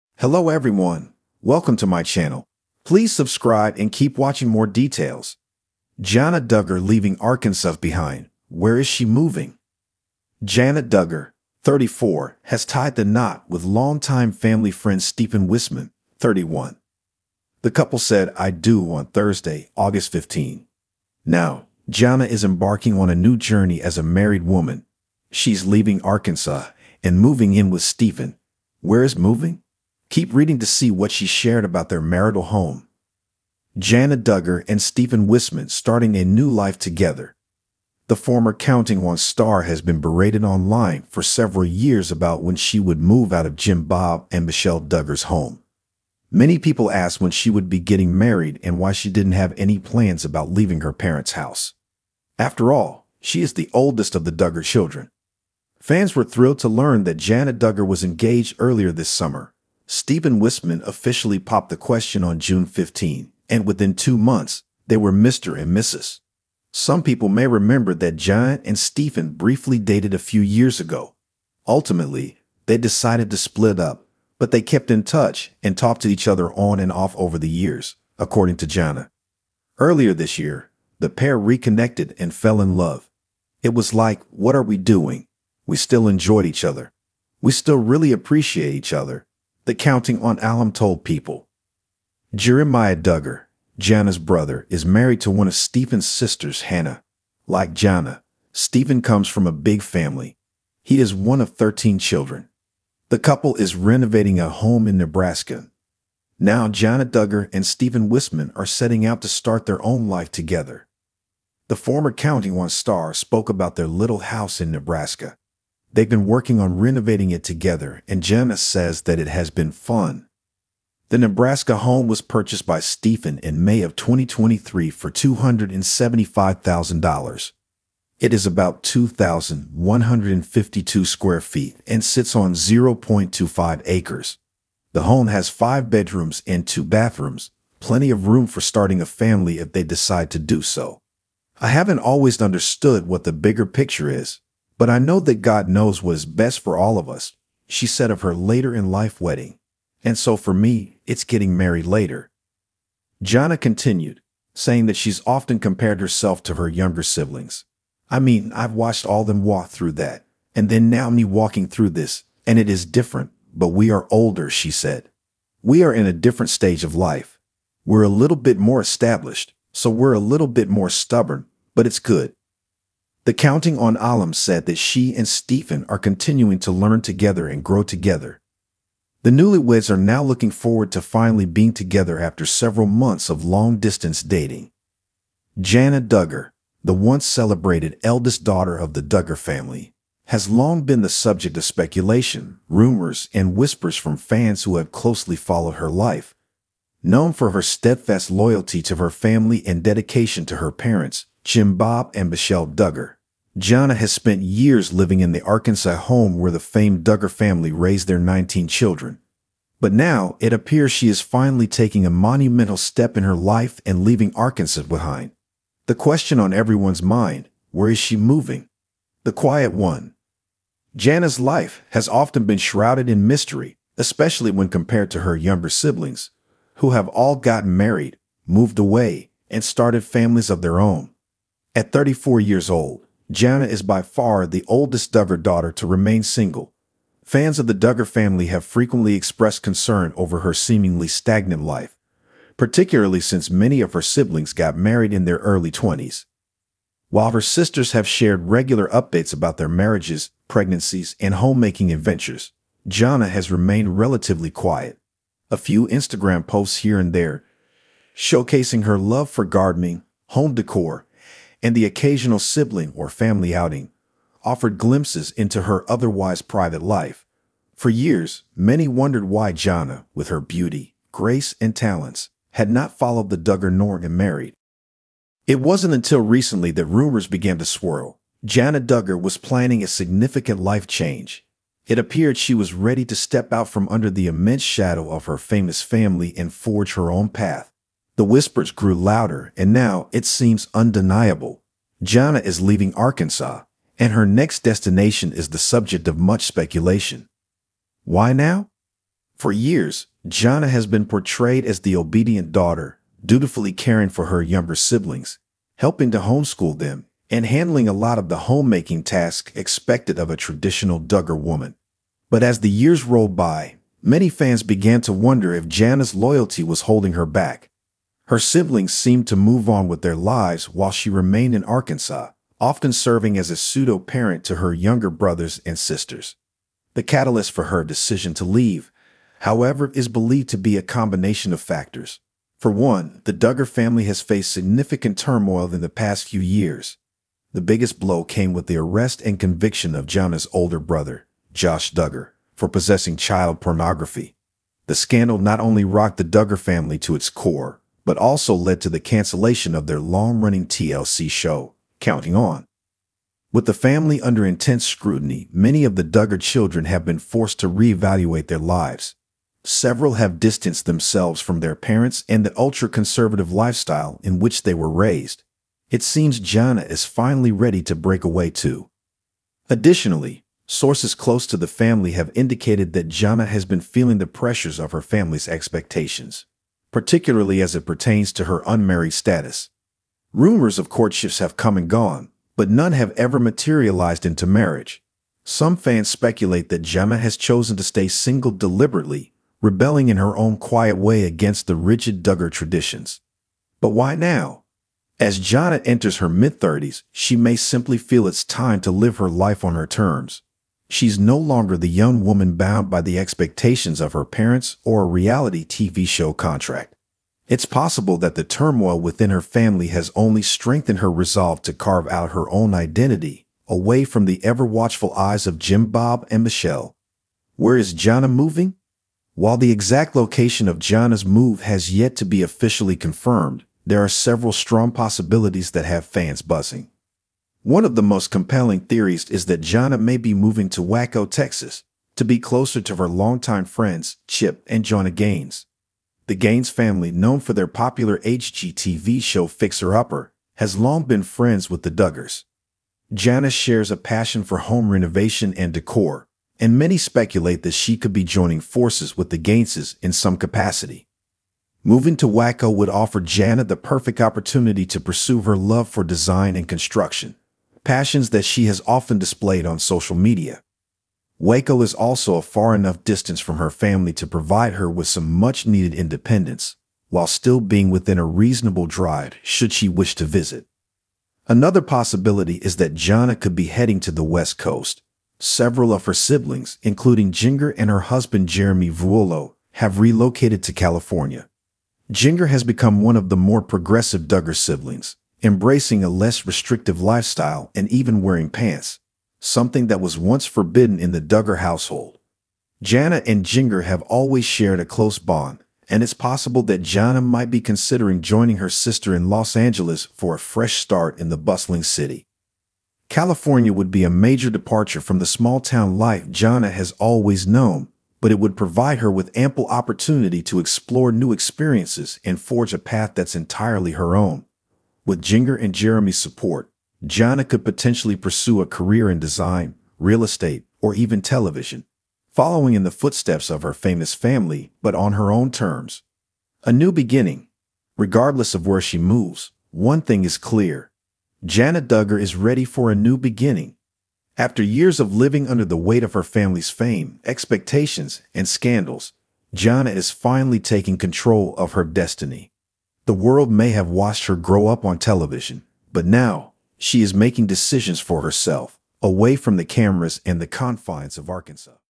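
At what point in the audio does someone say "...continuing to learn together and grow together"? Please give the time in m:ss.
2:55.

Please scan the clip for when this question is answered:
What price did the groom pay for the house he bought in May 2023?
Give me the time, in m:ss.
2:05.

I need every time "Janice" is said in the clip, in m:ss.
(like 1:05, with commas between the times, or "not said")
1:58, 7:23.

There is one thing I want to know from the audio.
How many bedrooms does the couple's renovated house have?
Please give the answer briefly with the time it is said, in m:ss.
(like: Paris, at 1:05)
5, at 2:15.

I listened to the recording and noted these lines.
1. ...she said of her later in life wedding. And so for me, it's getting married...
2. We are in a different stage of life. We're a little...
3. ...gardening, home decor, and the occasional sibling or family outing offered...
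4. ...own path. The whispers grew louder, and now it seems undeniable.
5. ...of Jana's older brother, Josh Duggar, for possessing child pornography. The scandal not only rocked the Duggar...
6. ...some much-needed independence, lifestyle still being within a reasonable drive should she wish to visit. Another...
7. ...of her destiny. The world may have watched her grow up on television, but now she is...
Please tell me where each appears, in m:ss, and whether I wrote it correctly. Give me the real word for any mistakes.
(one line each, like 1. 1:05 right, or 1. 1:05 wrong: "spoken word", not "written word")
1. 2:27 right
2. 2:45 right
3. 4:19 right
4. 4:47 right
5. 5:39 right
6. 7:45 wrong: "while", not "lifestyle"
7. 9:01 right.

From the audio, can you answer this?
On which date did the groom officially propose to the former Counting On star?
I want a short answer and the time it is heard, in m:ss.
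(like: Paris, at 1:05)
June 15, at 1:02.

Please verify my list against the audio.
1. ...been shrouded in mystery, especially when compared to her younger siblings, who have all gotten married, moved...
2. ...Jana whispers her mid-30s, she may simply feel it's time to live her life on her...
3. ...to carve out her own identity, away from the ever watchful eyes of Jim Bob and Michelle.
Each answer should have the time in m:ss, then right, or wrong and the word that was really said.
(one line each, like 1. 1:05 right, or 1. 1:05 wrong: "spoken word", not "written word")
1. 3:42 right
2. 6:35 wrong: "enters", not "whispers"
3. 6:51 right.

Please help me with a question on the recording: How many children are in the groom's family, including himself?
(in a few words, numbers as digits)
13.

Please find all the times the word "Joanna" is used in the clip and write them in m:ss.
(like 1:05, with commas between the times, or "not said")
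7:14.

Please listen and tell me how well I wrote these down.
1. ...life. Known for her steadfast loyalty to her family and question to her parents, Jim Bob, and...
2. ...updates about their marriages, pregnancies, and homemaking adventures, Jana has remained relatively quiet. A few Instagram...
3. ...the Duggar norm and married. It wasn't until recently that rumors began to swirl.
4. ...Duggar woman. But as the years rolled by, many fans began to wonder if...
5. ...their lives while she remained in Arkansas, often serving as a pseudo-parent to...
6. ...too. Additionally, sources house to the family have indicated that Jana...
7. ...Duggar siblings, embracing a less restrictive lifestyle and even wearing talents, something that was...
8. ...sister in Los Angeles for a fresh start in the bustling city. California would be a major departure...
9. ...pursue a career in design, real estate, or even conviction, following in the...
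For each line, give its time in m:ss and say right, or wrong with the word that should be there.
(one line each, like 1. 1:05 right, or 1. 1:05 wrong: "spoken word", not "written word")
1. 3:15 wrong: "dedication", not "question"
2. 4:08 right
3. 4:33 right
4. 5:10 right
5. 5:20 right
6. 6:08 wrong: "close", not "house"
7. 8:04 wrong: "pants", not "talents"
8. 8:18 right
9. 8:38 wrong: "television", not "conviction".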